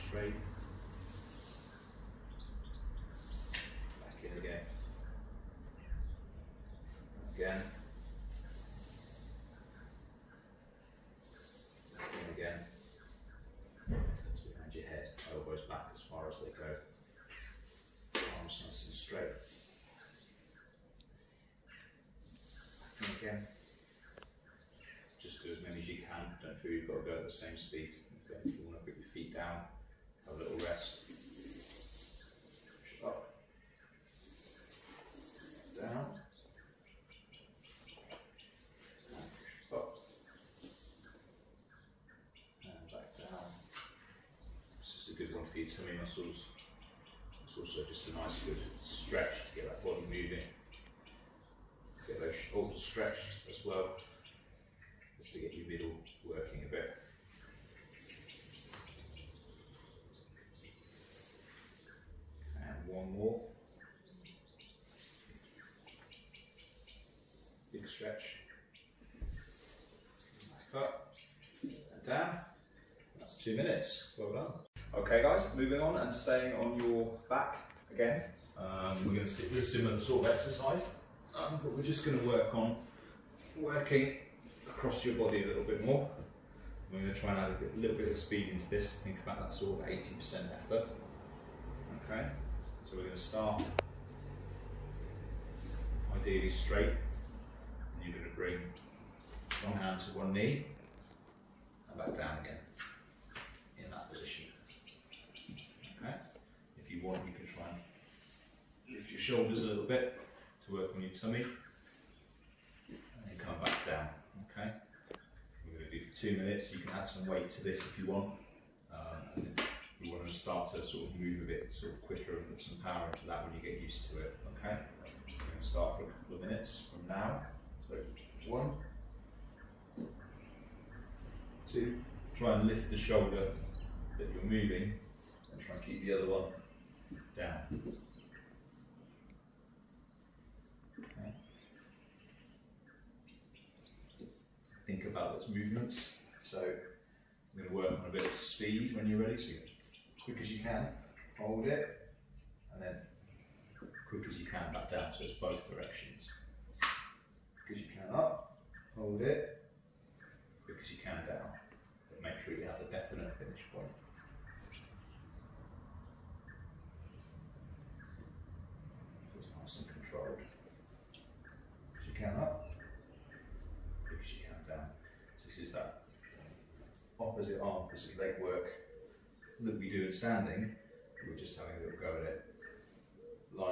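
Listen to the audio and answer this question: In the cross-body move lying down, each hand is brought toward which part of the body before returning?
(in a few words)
One knee.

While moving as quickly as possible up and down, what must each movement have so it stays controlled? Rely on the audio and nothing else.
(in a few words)
A definite finish point.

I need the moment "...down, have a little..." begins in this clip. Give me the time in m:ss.
0:29.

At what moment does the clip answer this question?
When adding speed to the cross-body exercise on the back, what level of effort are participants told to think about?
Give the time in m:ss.
1:29.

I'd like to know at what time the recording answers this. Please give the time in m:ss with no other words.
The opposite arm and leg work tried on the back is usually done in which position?
3:00.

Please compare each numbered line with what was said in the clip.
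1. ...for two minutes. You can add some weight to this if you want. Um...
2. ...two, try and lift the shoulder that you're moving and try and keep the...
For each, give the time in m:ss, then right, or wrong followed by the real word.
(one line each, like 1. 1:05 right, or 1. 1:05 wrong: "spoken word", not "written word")
1. 1:56 right
2. 2:11 right.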